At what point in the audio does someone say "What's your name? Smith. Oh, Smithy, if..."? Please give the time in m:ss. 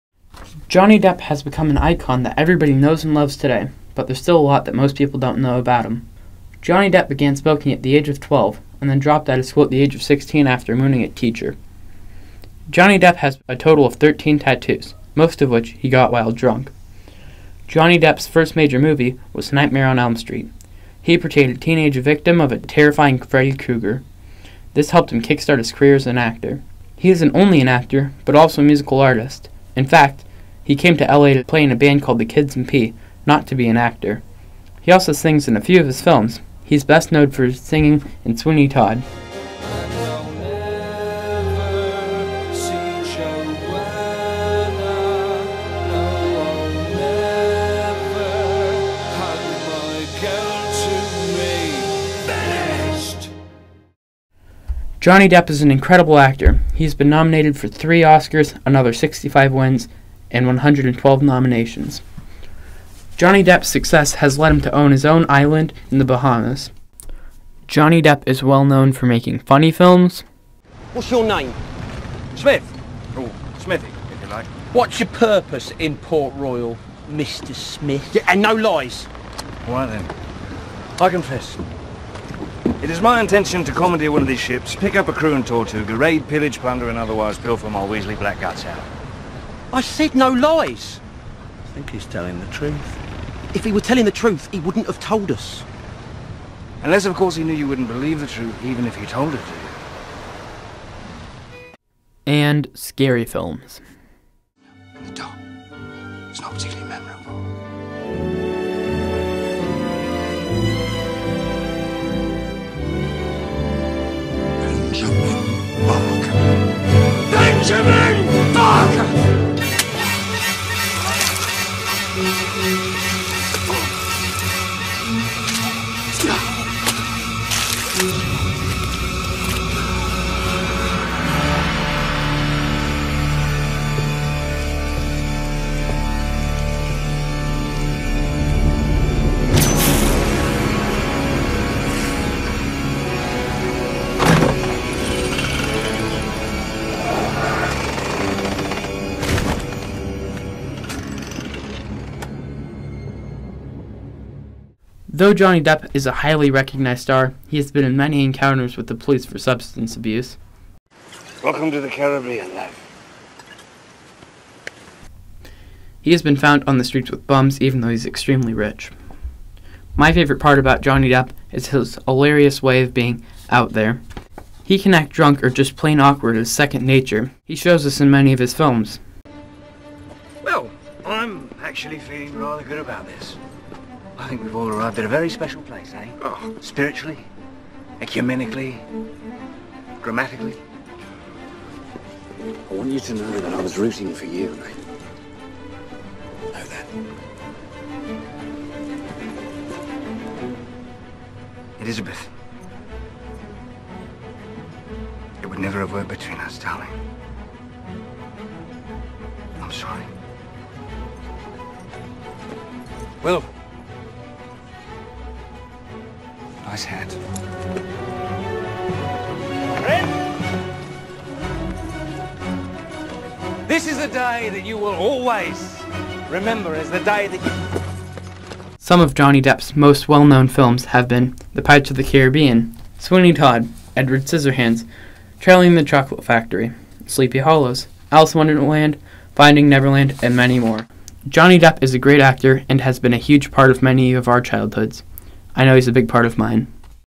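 1:10.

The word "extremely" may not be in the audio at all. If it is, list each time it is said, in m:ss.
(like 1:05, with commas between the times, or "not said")
2:48.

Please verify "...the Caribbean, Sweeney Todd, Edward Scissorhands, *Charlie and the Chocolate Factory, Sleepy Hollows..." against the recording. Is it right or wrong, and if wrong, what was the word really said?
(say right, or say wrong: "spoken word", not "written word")
right.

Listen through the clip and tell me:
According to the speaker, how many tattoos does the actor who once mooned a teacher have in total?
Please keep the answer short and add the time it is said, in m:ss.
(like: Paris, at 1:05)
13, at 0:13.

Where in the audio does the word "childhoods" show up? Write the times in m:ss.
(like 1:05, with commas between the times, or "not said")
4:04.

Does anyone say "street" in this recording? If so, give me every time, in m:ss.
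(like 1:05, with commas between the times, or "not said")
0:20, 2:46.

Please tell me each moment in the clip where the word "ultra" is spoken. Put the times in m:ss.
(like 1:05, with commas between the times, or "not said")
not said.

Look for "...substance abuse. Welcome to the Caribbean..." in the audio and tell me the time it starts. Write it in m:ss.
2:39.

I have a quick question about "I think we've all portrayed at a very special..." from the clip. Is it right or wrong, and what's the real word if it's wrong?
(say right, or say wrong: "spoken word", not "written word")
wrong: "arrived", not "portrayed".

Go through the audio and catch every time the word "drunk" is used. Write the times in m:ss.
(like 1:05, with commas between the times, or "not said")
0:16, 2:55.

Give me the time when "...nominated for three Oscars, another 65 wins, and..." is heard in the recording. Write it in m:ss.
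0:57.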